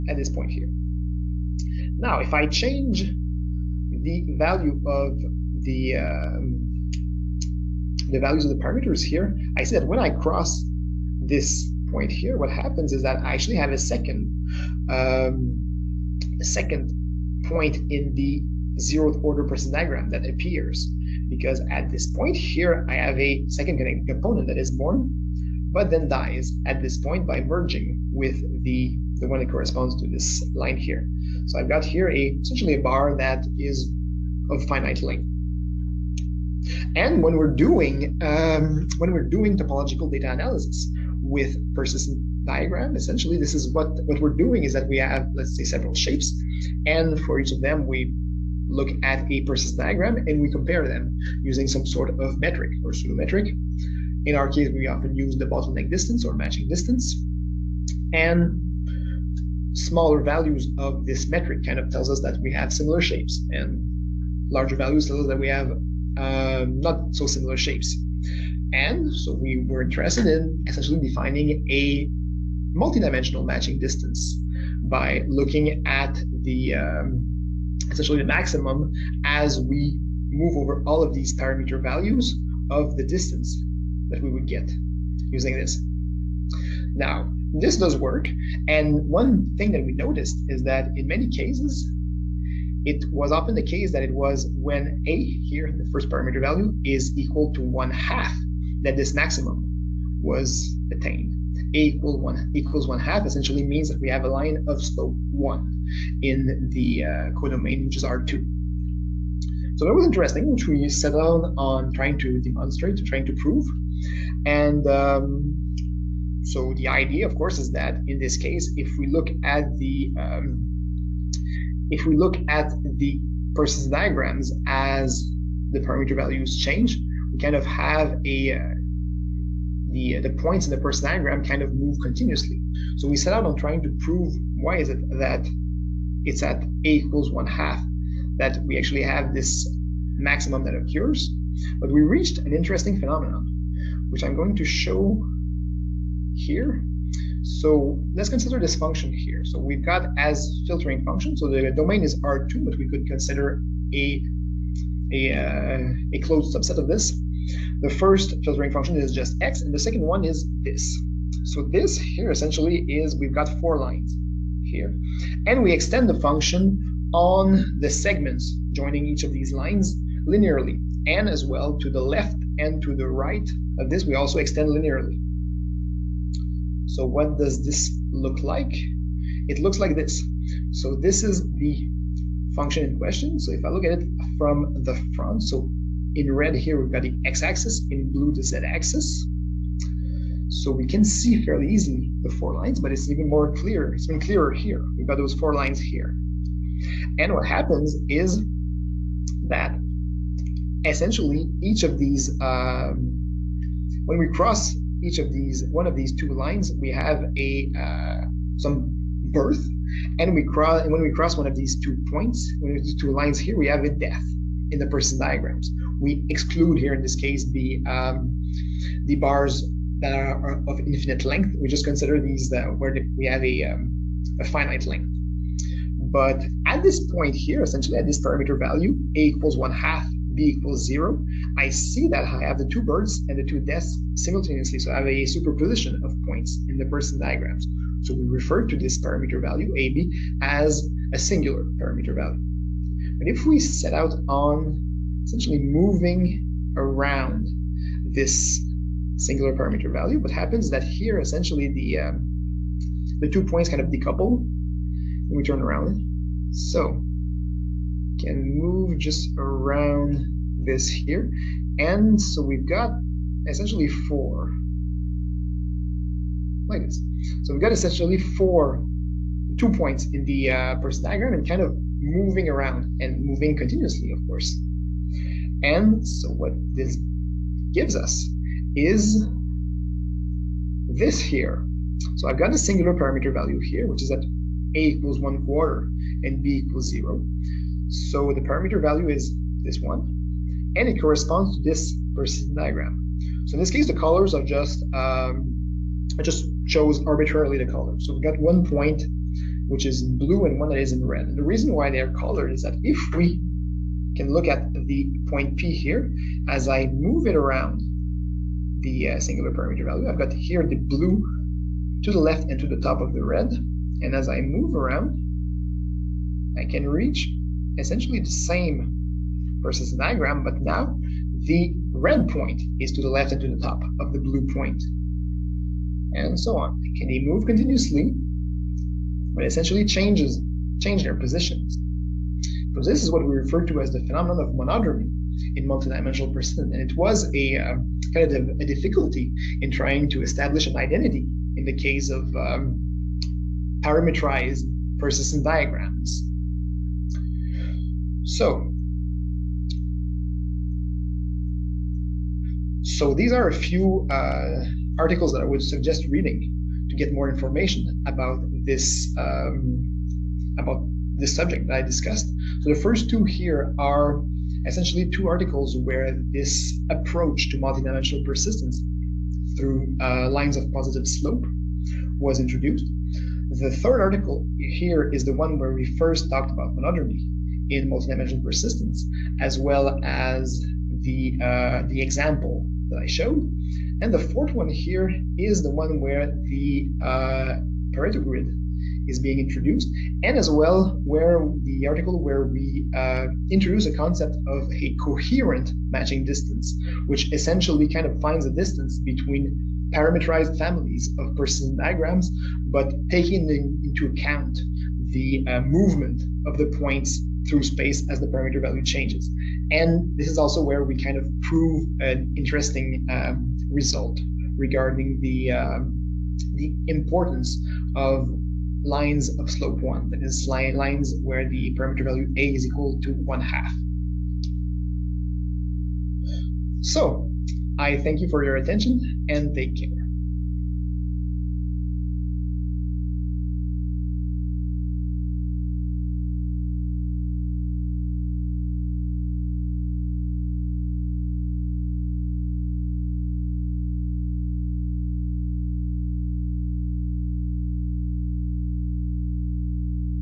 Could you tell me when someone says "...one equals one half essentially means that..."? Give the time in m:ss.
1:42.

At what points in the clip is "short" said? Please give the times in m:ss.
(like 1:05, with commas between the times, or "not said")
not said.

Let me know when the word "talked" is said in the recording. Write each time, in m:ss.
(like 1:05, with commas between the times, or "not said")
6:16.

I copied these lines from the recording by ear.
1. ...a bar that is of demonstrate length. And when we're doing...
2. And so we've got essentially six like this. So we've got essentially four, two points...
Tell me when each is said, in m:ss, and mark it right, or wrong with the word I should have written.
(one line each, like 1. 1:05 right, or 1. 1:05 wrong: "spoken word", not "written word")
1. 0:32 wrong: "finite", not "demonstrate"
2. 4:21 wrong: "four", not "six".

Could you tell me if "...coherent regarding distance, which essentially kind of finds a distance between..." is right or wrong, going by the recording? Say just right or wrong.
wrong.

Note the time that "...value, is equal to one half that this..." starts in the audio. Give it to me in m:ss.
1:36.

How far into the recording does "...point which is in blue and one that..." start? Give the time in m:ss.
4:58.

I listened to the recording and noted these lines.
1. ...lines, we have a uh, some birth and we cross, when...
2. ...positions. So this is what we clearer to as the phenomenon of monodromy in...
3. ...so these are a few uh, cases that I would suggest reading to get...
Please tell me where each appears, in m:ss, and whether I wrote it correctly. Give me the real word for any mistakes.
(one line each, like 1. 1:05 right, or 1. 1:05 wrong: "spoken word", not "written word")
1. 3:26 right
2. 5:31 wrong: "refer", not "clearer"
3. 5:52 wrong: "articles", not "cases".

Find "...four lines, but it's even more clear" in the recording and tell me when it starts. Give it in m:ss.
3:12.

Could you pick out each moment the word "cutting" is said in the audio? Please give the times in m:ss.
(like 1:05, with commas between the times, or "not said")
not said.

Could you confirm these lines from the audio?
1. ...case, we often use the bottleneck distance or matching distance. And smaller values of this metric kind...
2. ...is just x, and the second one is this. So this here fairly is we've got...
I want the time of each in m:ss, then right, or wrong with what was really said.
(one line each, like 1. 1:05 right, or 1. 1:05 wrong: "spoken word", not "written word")
1. 0:54 right
2. 2:38 wrong: "essentially", not "fairly".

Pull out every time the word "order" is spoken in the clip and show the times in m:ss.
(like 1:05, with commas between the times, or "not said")
0:19.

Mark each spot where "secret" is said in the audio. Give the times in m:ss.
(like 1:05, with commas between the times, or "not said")
not said.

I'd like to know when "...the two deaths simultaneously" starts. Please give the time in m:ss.
3:53.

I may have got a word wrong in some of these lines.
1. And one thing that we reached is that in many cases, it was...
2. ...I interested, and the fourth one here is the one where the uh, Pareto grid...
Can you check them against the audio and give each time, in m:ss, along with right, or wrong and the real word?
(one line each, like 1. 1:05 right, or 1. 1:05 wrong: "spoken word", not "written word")
1. 1:28 wrong: "noticed", not "reached"
2. 6:23 wrong: "showed", not "interested".